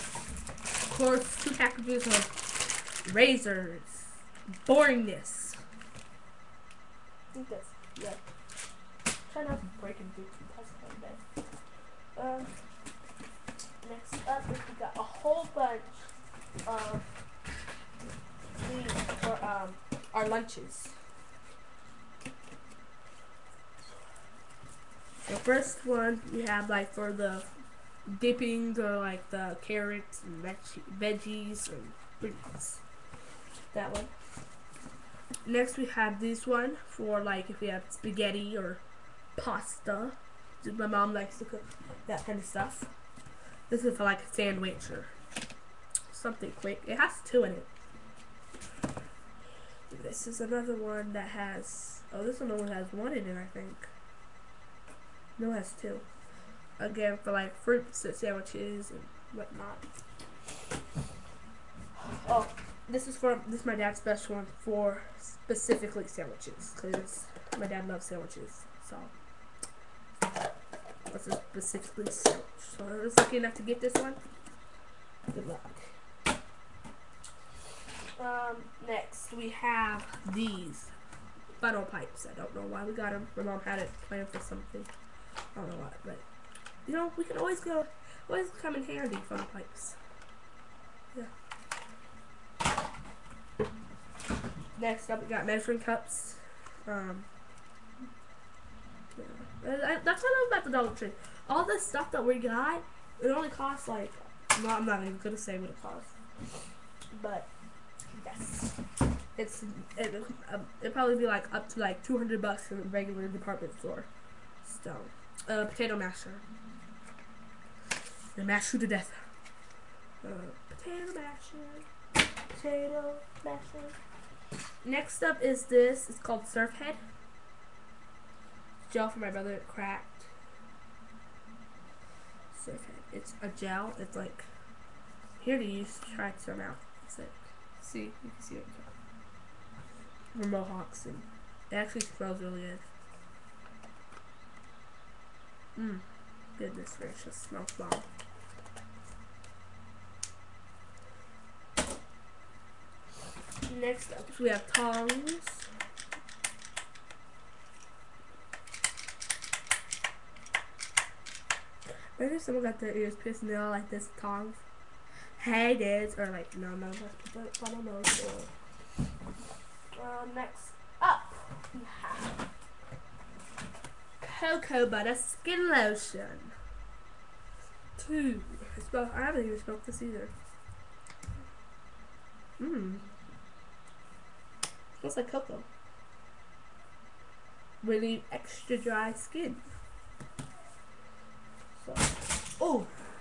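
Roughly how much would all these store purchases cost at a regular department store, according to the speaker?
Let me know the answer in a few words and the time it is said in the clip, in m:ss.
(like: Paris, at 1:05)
200 bucks, at 1:52.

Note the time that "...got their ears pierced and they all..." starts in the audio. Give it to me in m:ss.
2:42.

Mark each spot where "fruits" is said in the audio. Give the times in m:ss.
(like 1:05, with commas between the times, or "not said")
0:32, 0:57.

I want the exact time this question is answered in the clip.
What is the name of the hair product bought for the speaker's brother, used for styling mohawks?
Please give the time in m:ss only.
2:06.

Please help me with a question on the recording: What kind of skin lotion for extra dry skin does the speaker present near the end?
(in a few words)
cocoa butter.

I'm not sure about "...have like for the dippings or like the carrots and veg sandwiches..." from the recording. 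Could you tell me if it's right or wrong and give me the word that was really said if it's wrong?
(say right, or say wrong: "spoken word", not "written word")
wrong: "veggies", not "sandwiches".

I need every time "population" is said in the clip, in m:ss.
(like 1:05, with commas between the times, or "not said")
not said.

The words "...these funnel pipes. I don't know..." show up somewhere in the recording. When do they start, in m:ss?
1:20.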